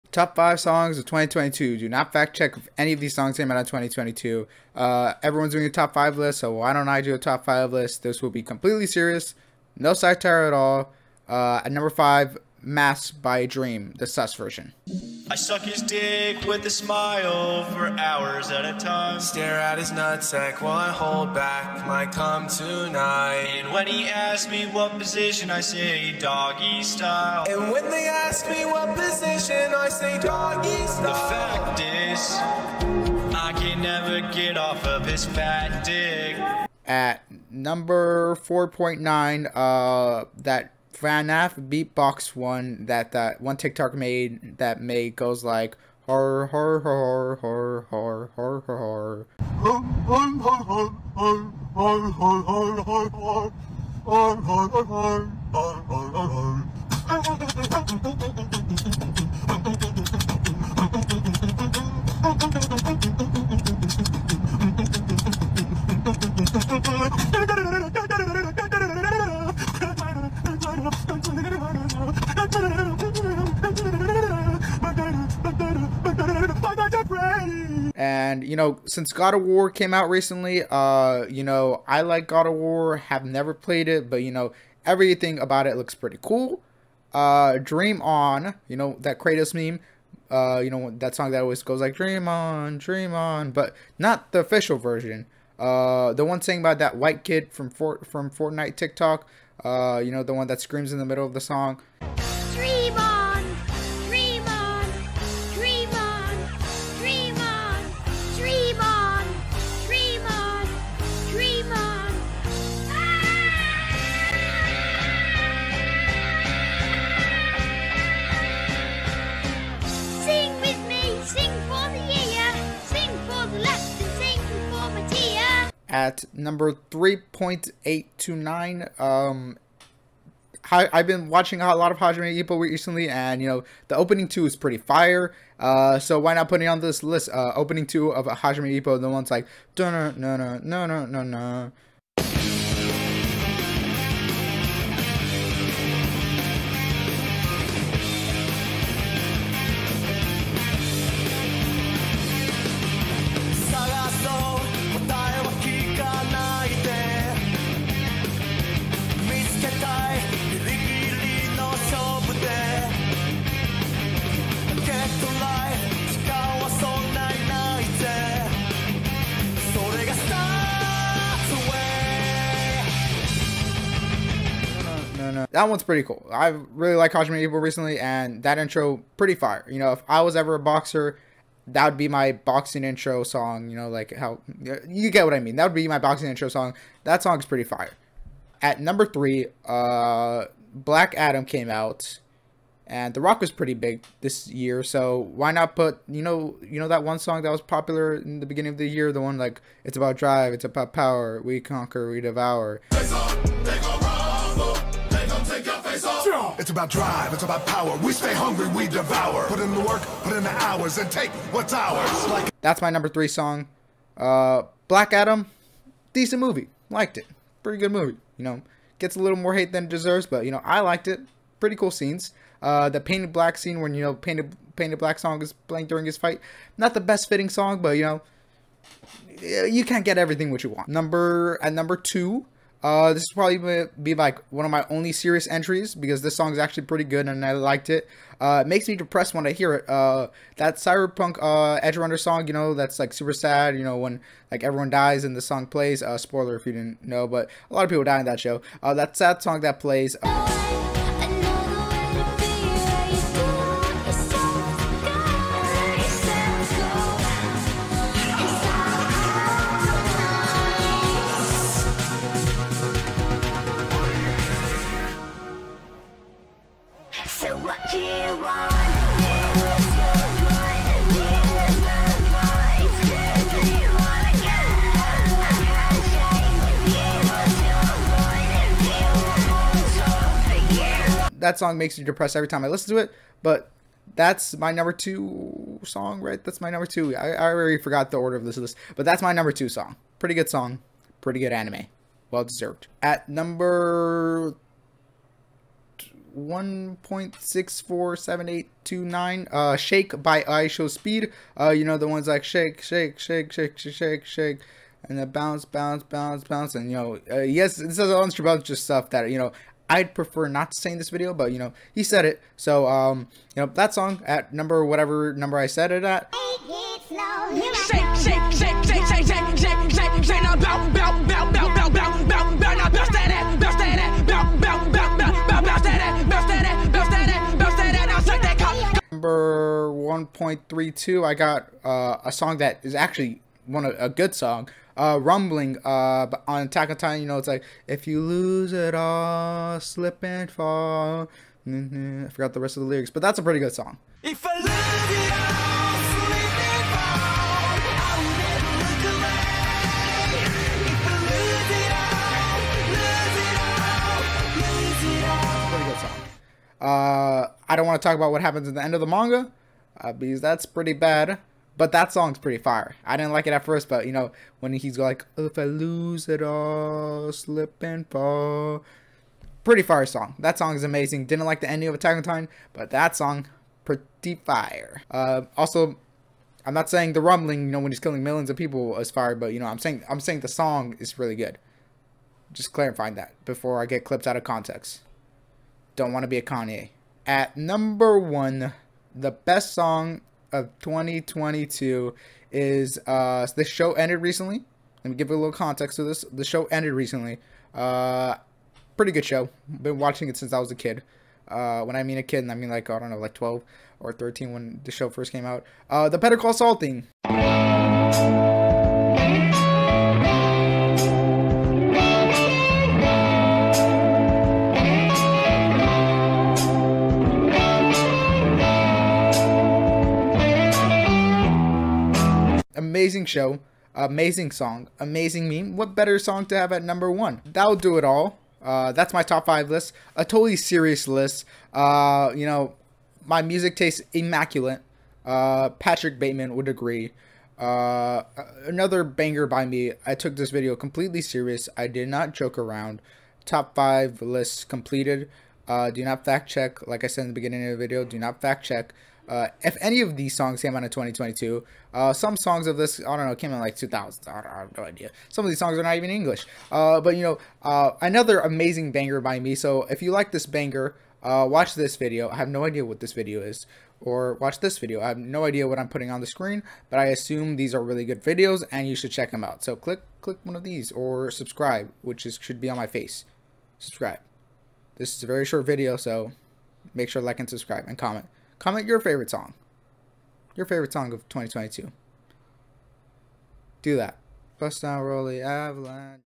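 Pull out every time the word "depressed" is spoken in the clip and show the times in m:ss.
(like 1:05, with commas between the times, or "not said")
3:58, 4:42.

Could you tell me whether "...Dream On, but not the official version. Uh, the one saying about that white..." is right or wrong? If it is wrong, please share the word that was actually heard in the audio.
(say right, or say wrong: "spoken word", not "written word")
right.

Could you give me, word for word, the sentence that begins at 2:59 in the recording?
You know, if I was ever a boxer, that would be my boxing intro song.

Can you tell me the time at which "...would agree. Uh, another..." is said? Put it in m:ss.
7:16.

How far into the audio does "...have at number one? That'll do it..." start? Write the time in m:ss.
7:06.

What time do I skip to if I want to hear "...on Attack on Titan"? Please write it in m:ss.
5:36.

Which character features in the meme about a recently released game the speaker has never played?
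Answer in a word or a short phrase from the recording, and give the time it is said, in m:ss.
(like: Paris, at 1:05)
Kratos, at 1:29.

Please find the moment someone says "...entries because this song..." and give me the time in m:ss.
3:55.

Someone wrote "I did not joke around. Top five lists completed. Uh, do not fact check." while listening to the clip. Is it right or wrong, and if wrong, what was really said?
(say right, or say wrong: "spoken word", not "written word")
right.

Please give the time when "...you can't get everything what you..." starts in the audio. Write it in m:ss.
3:49.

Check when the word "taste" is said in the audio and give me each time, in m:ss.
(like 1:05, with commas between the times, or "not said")
7:13.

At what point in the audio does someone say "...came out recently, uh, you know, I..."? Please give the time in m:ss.
1:19.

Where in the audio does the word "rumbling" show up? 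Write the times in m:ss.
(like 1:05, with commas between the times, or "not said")
5:35, 6:17.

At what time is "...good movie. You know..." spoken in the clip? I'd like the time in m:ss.
3:37.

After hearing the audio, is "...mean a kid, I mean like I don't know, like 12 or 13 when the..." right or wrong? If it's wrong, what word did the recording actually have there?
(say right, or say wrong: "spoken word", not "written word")
right.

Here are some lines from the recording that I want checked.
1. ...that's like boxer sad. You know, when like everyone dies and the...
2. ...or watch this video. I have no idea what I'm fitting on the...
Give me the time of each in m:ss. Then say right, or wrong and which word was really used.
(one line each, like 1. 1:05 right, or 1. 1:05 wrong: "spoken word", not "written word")
1. 4:02 wrong: "super", not "boxer"
2. 7:43 wrong: "putting", not "fitting".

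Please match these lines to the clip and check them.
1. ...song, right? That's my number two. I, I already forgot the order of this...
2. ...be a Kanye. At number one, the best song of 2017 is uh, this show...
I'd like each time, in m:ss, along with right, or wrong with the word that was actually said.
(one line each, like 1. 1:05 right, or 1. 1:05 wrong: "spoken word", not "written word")
1. 4:45 right
2. 6:26 wrong: "2022", not "2017".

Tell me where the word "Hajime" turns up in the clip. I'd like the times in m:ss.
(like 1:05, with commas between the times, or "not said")
2:11, 2:18, 2:57.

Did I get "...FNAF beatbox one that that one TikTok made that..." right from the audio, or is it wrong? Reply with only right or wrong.
right.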